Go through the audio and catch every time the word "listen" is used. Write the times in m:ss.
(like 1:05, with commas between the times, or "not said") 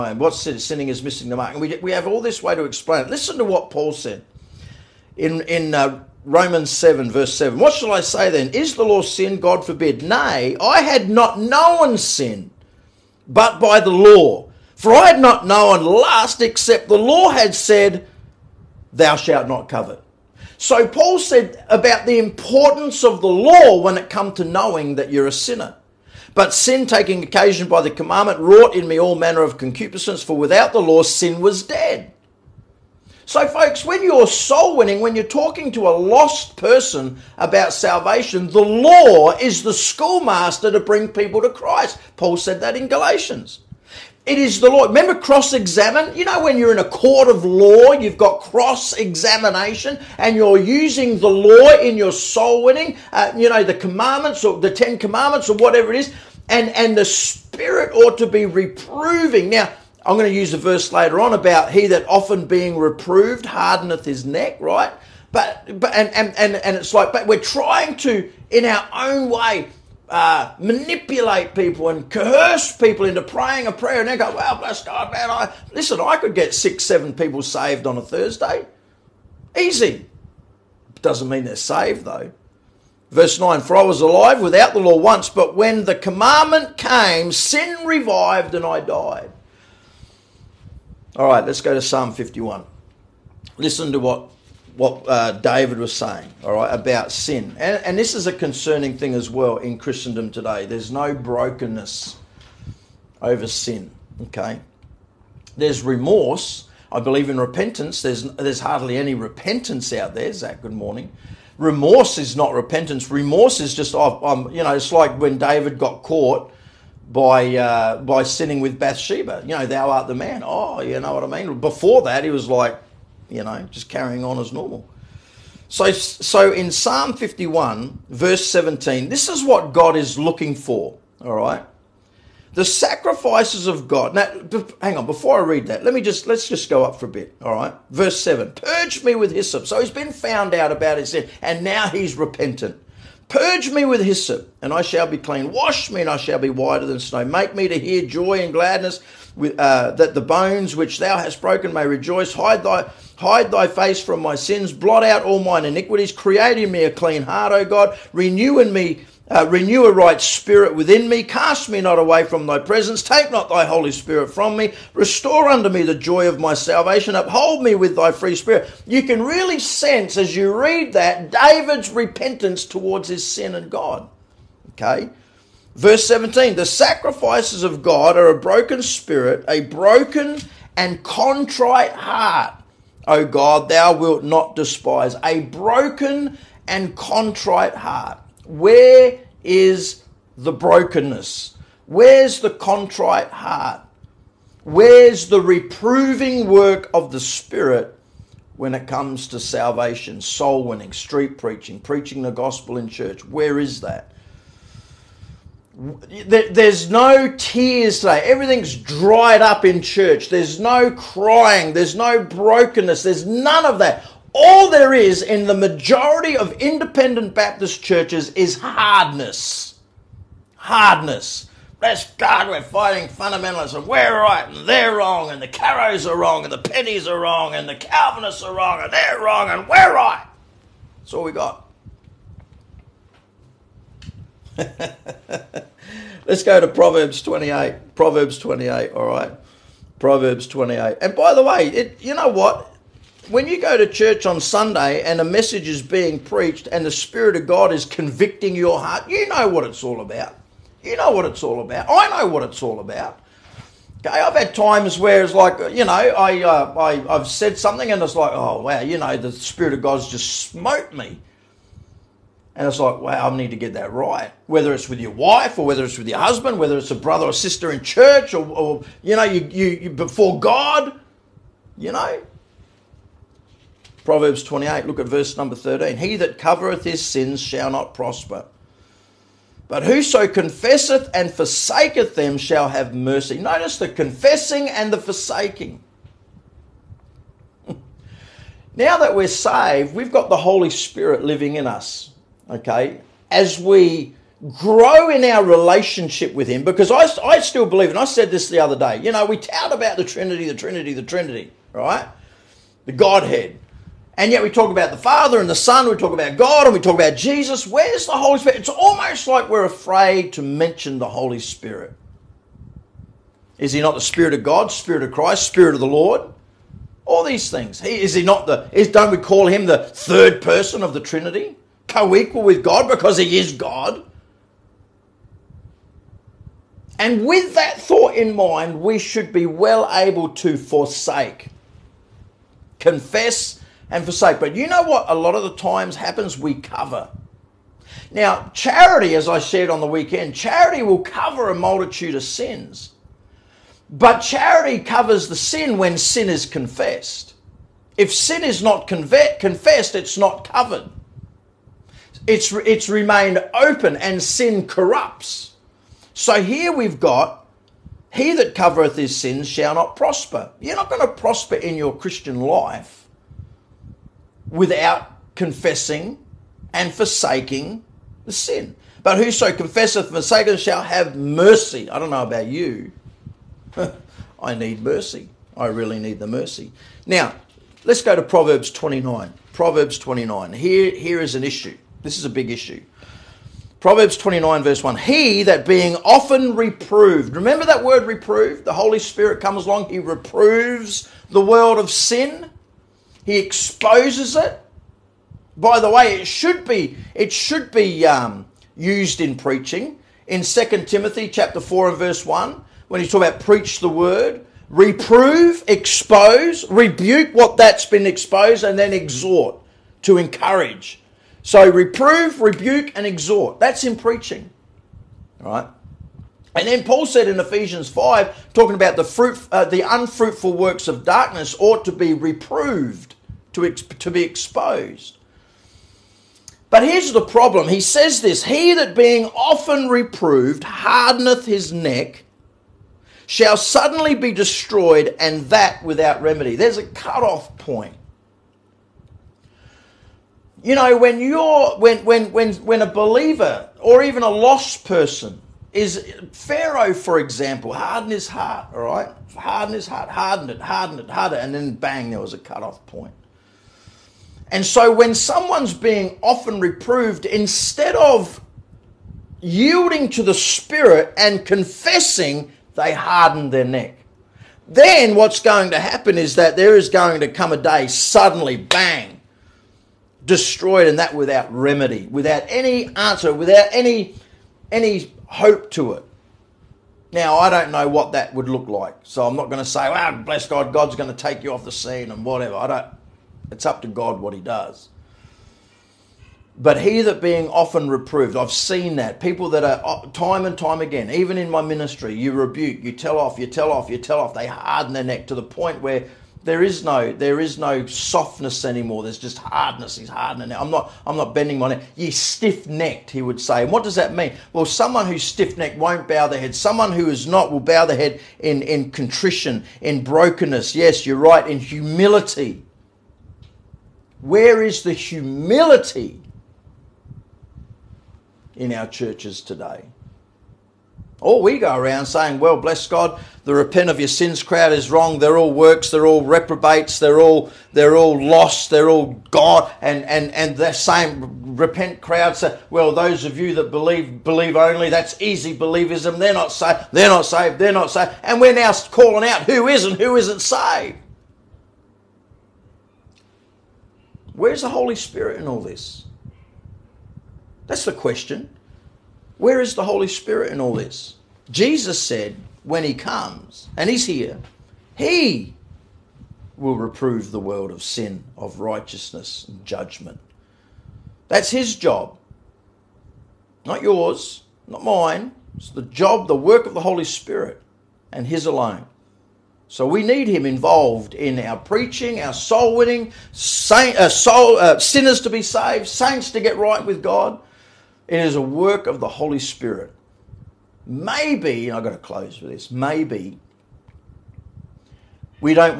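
0:03, 1:15, 1:33.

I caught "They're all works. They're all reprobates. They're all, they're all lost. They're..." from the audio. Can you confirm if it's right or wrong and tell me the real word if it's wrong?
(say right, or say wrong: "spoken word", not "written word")
right.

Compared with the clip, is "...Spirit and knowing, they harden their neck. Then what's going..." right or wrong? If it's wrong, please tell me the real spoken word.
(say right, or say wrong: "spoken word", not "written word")
wrong: "confessing", not "knowing".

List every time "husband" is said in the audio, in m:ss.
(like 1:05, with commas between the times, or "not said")
4:26.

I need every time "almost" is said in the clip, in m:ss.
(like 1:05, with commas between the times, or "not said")
5:08.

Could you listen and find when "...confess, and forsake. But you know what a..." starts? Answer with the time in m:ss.
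5:32.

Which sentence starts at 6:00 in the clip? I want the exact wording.
You're not going to prosper in your Christian life without confessing and forsaking the sin.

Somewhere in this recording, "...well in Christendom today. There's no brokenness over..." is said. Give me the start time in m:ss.
1:39.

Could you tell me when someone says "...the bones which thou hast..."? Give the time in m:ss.
2:30.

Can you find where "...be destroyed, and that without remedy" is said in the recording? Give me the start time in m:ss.
7:14.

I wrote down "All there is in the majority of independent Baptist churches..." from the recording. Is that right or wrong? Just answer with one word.
right.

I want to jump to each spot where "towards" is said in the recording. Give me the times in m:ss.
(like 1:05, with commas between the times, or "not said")
2:52.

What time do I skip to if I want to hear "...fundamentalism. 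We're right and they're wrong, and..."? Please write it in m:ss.
3:43.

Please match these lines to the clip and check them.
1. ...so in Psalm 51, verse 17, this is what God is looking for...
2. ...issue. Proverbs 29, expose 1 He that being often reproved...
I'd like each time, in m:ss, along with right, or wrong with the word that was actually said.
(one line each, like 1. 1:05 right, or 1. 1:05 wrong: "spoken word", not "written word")
1. 2:05 right
2. 6:22 wrong: "verse", not "expose".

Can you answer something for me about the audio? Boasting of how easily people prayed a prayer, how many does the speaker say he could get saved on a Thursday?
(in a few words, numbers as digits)
6 or 7.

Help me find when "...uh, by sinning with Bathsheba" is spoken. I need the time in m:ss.
1:57.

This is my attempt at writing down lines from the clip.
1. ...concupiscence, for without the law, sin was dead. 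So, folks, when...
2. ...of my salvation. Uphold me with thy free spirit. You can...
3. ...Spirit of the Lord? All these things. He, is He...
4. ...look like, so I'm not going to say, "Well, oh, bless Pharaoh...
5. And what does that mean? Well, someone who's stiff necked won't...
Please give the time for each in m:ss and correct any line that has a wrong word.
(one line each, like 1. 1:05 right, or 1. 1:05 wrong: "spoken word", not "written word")
1. 0:29 right
2. 2:46 right
3. 5:15 right
4. 7:58 wrong: "God", not "Pharaoh"
5. 8:23 right.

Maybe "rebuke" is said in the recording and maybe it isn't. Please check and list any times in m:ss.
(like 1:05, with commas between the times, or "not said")
6:46, 6:52, 8:12.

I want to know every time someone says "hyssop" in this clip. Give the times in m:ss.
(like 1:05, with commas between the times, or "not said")
2:19, 2:24.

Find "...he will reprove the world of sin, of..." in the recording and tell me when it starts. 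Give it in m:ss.
9:14.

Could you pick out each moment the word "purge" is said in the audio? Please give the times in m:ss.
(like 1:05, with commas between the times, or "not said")
2:18, 2:23.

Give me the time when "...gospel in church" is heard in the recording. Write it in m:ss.
3:22.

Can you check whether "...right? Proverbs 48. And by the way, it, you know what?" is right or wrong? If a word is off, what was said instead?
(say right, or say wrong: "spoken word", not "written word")
wrong: "28", not "48".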